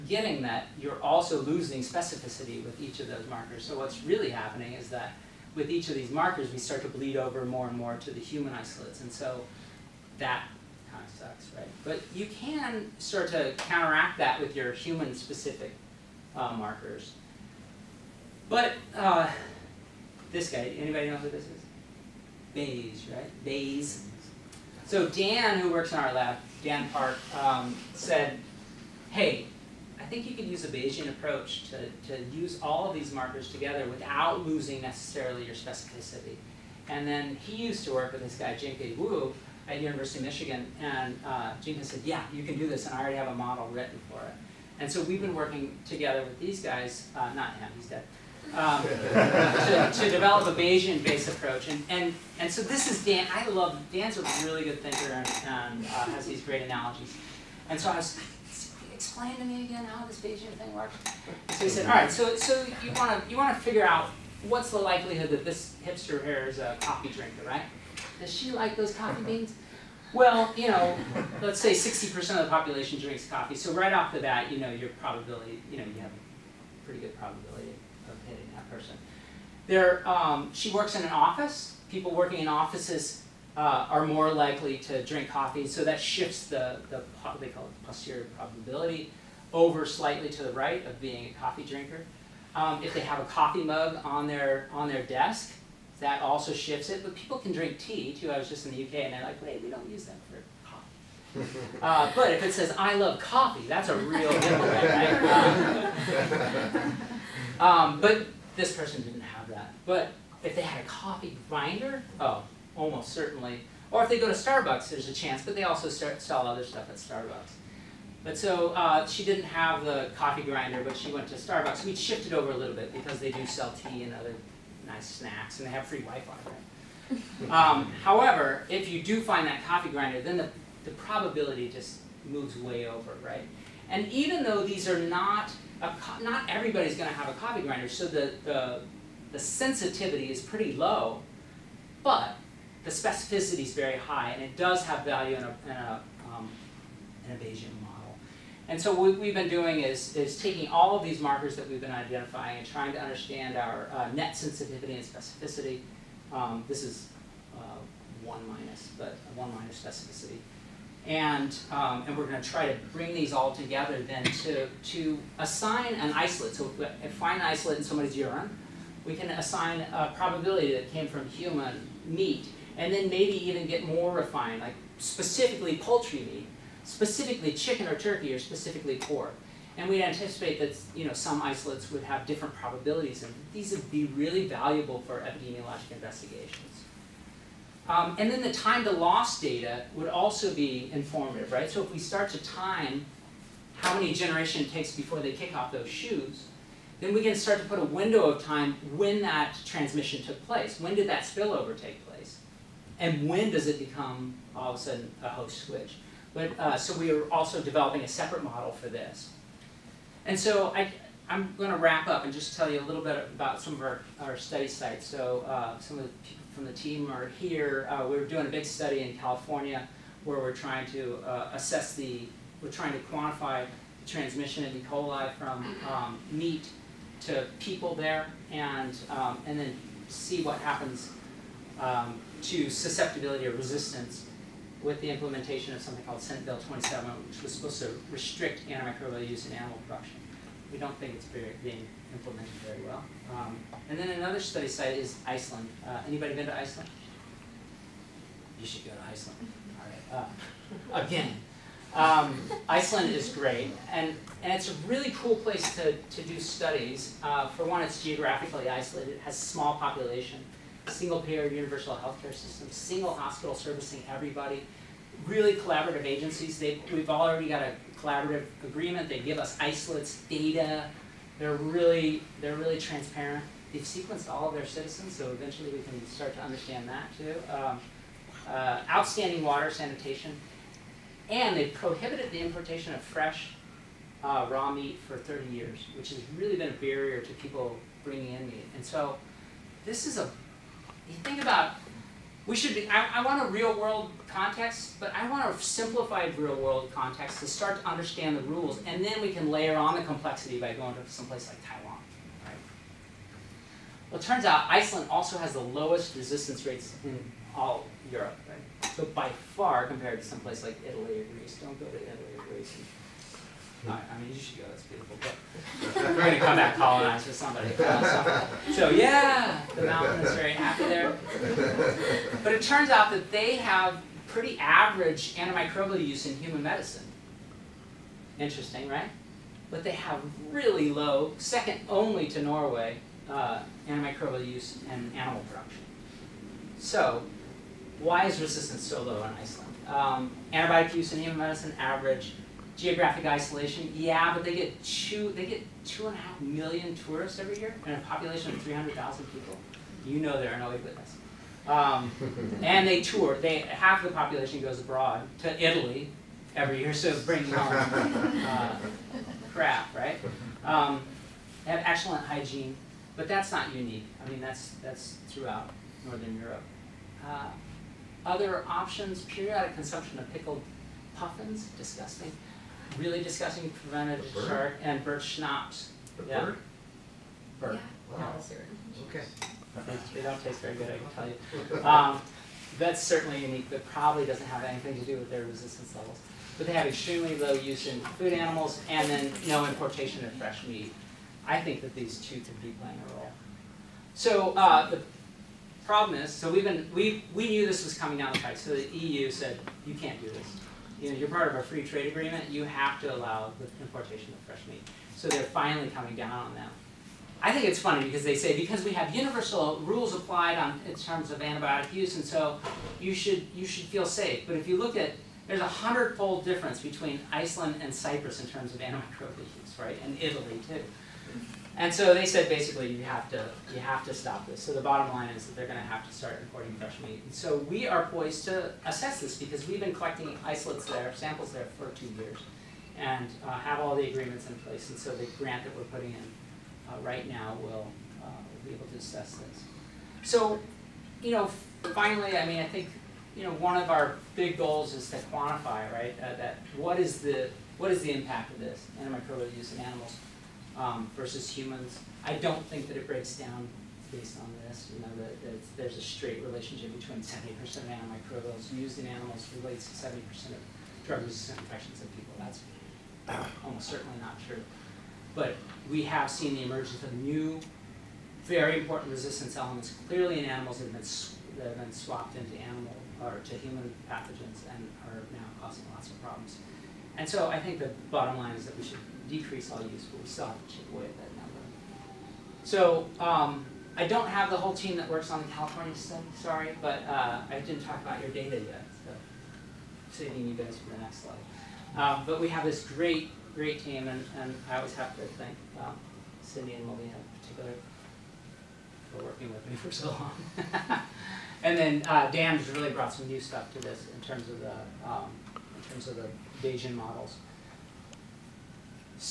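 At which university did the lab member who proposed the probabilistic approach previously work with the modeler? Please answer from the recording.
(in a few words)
University of Michigan.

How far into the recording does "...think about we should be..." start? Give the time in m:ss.
4:51.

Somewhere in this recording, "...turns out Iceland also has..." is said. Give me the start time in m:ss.
5:04.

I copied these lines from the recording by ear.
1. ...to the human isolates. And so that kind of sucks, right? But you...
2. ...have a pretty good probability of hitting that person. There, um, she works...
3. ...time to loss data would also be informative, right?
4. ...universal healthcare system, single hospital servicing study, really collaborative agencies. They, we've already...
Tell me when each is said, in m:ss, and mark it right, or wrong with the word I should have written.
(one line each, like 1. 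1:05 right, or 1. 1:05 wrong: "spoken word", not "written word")
1. 0:07 right
2. 1:16 right
3. 3:08 right
4. 4:21 wrong: "everybody", not "study".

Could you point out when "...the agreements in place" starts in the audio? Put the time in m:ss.
7:13.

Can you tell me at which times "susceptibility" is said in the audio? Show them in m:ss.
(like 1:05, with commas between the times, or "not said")
3:52.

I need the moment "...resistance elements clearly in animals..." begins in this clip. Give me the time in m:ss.
7:49.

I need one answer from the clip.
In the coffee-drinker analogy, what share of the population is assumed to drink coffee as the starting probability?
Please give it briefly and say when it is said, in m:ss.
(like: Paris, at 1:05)
60%, at 1:11.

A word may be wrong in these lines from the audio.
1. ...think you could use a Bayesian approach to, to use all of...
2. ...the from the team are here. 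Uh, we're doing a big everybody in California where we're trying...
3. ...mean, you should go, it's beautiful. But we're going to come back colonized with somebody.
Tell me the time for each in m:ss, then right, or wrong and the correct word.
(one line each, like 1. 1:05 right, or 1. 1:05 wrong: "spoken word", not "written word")
1. 0:30 right
2. 3:36 wrong: "study", not "everybody"
3. 5:14 right.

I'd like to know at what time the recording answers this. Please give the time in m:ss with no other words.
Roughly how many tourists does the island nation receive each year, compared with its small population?
5:45.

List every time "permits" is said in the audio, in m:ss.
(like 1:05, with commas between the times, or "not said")
not said.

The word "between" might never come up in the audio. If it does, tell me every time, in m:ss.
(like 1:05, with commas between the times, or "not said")
6:56, 7:36.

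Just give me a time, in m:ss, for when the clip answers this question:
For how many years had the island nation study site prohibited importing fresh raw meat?
4:45.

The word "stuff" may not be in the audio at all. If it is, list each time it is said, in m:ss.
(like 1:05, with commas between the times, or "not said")
1:56, 8:23.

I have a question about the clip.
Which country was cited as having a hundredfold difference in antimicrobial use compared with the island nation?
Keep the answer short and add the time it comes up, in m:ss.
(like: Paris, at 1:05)
Cyprus, at 6:57.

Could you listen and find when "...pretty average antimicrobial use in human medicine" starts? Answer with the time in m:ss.
5:24.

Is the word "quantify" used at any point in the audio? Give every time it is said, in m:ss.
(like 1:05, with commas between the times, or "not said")
3:43, 7:25.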